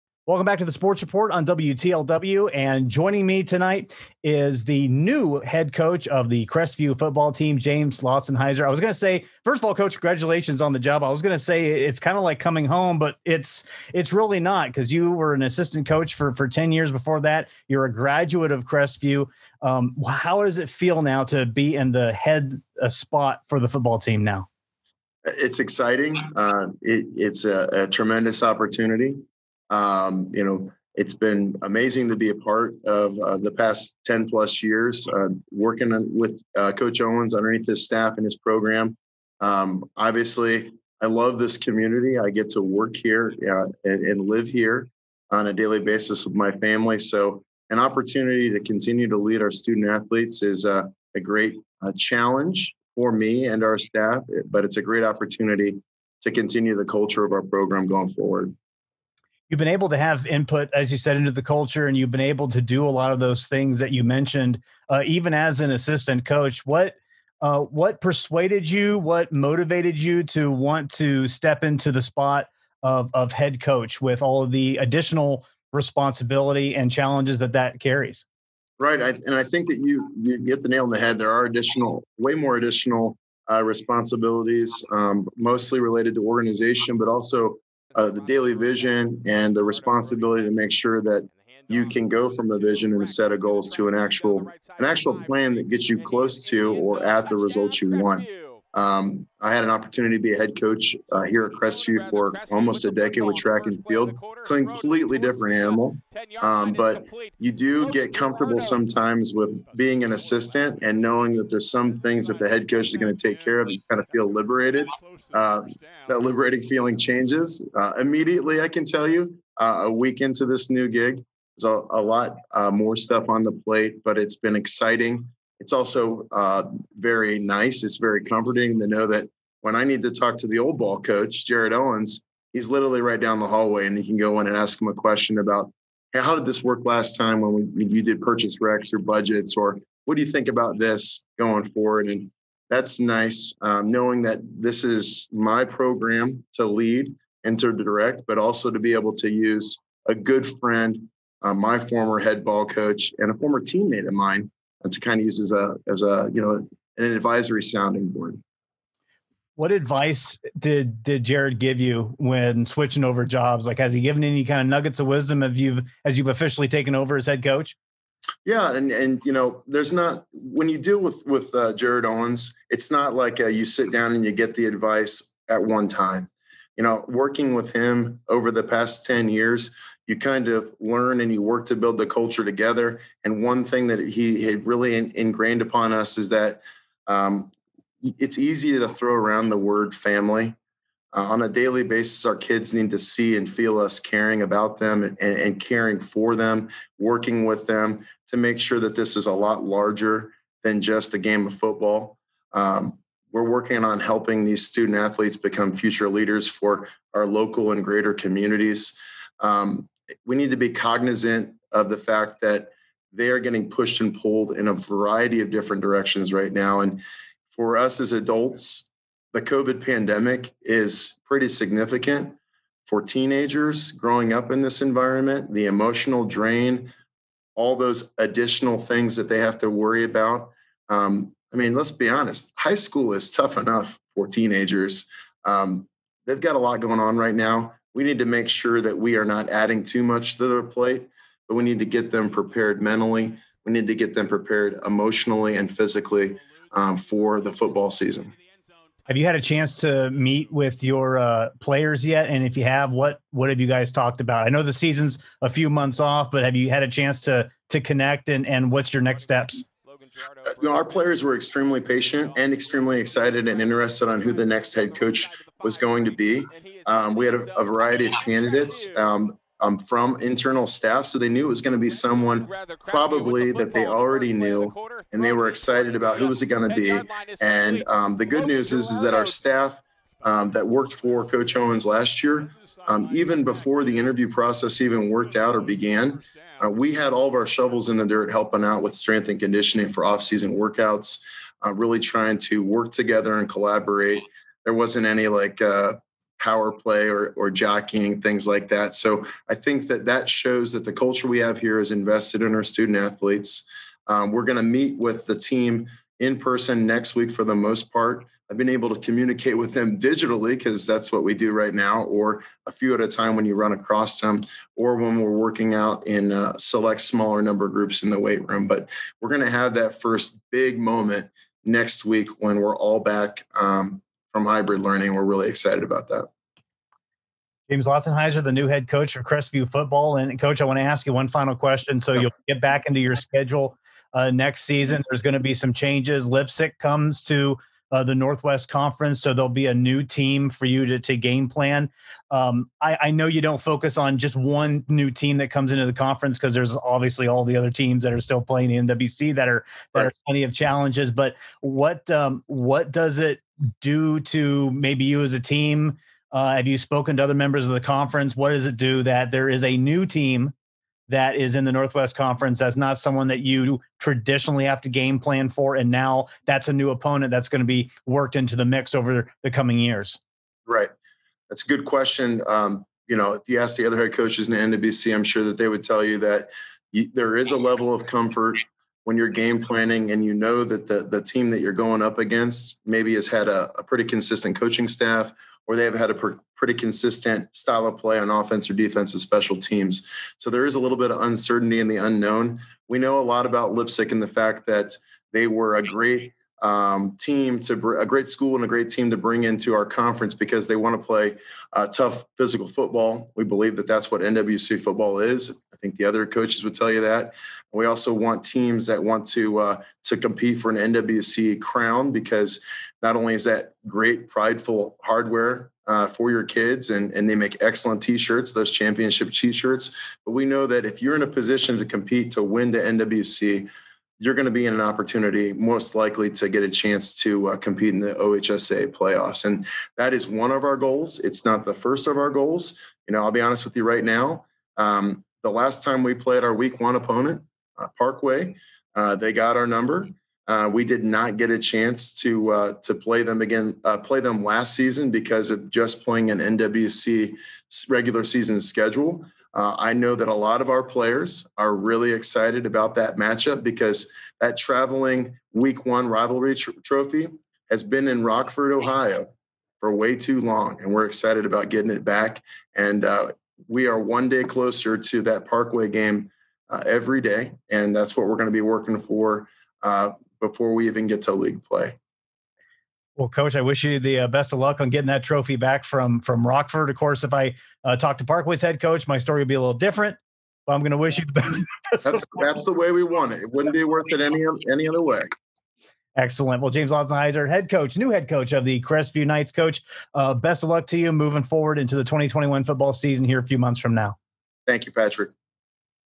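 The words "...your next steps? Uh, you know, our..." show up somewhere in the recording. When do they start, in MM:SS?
04:18.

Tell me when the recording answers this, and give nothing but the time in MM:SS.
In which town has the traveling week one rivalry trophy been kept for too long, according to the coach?
07:38.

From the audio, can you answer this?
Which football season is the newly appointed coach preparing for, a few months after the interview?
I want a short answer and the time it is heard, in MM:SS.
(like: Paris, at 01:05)
2021, at 08:12.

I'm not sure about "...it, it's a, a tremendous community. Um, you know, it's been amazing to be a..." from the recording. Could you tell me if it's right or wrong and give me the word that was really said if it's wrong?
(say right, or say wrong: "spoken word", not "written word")
wrong: "opportunity", not "community".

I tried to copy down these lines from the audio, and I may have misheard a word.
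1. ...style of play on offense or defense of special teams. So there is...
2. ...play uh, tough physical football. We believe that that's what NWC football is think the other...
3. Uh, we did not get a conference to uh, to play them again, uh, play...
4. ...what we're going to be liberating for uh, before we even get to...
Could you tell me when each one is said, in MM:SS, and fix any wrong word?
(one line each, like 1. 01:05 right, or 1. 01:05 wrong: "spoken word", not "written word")
1. 06:27 right
2. 06:41 right
3. 07:20 wrong: "chance", not "conference"
4. 07:48 wrong: "working", not "liberating".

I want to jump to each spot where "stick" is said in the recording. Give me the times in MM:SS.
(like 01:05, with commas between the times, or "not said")
not said.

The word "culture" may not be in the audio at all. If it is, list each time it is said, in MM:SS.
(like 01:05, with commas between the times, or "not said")
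00:56, 01:01, 03:02, 05:00.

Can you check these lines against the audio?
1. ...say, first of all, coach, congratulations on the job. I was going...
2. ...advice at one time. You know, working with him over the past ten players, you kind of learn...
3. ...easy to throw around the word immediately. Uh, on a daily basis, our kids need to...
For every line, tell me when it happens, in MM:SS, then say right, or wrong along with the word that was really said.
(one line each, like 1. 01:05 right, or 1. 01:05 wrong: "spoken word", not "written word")
1. 00:08 right
2. 02:54 wrong: "years", not "players"
3. 03:08 wrong: "family", not "immediately".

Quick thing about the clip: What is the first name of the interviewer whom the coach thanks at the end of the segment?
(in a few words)
Patrick.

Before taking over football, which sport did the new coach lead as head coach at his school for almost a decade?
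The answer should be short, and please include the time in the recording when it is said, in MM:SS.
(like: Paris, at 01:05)
Track and field, at 01:43.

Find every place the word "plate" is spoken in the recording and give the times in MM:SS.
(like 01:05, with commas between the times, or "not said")
02:03, 04:00.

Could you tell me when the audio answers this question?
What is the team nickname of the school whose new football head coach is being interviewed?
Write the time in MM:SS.
08:08.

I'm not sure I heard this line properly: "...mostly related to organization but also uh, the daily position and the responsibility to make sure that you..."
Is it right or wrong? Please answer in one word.
wrong.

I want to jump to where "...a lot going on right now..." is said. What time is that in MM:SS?
03:56.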